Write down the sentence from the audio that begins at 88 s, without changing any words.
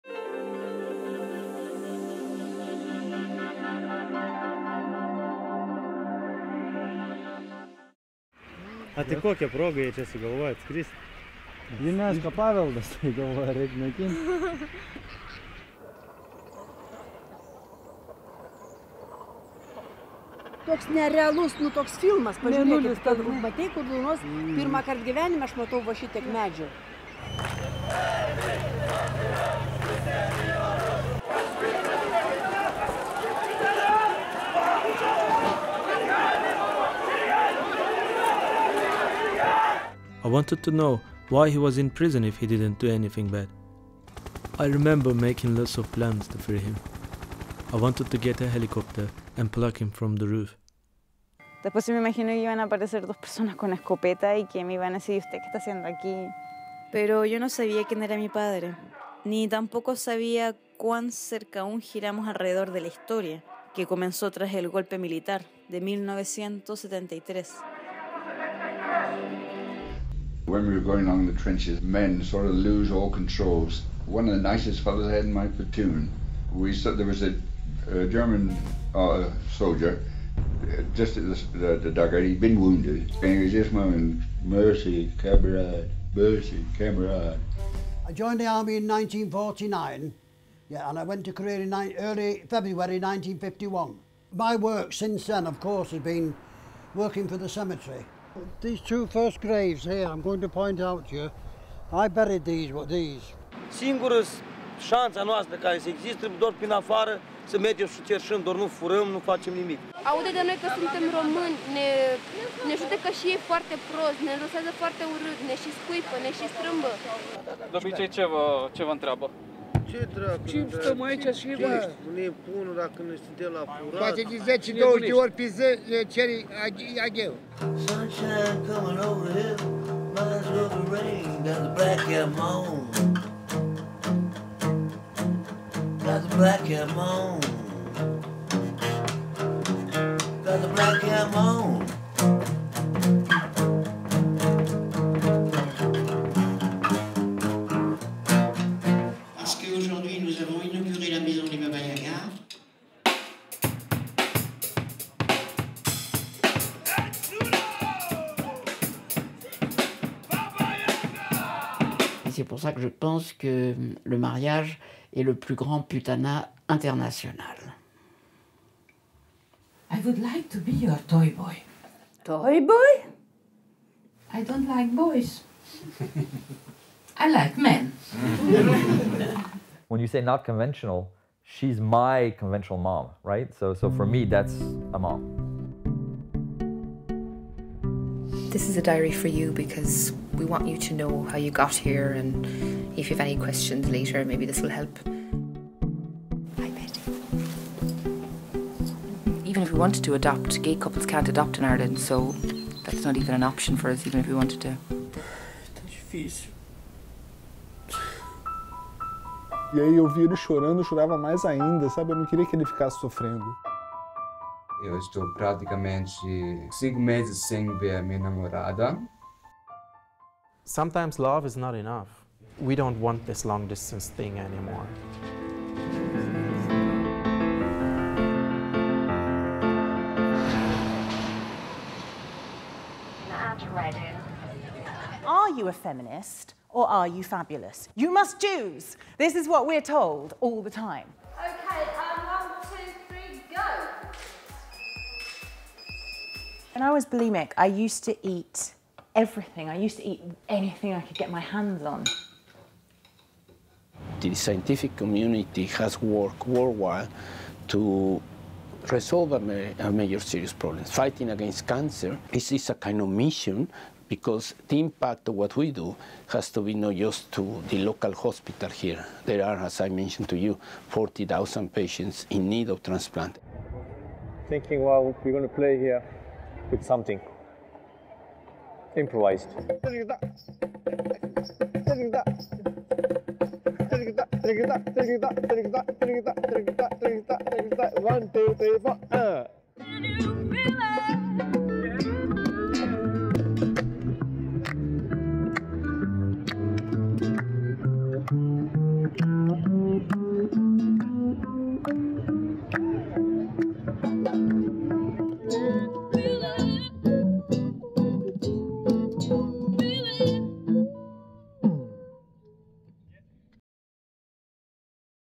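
I joined the army in 1949, yeah, and I went to Korea in early February 1951.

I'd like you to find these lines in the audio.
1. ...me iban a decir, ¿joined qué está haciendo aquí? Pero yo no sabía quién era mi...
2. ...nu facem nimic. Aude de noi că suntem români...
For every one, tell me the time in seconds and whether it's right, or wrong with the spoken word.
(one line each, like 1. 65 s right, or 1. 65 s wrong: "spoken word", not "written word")
1. 54 s wrong: "usted", not "joined"
2. 109 s right.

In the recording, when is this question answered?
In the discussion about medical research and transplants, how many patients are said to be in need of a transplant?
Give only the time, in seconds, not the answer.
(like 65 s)
270 s.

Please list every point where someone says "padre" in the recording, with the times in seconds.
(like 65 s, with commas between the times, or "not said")
58 s.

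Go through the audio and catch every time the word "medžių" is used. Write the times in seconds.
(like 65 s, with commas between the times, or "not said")
26 s.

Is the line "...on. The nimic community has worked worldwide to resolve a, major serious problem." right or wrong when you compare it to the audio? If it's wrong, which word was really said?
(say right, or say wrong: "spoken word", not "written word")
wrong: "scientific", not "nimic".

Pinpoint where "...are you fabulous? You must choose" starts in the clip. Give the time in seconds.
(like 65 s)
236 s.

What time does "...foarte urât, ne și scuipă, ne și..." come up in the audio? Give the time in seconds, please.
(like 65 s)
114 s.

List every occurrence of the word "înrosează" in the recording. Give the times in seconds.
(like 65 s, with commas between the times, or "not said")
114 s.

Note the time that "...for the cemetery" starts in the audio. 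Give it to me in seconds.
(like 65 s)
97 s.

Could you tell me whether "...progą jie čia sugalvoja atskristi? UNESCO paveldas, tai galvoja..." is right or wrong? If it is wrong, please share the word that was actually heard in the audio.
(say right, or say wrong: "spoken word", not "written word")
right.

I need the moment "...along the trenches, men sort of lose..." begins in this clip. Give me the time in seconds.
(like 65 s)
71 s.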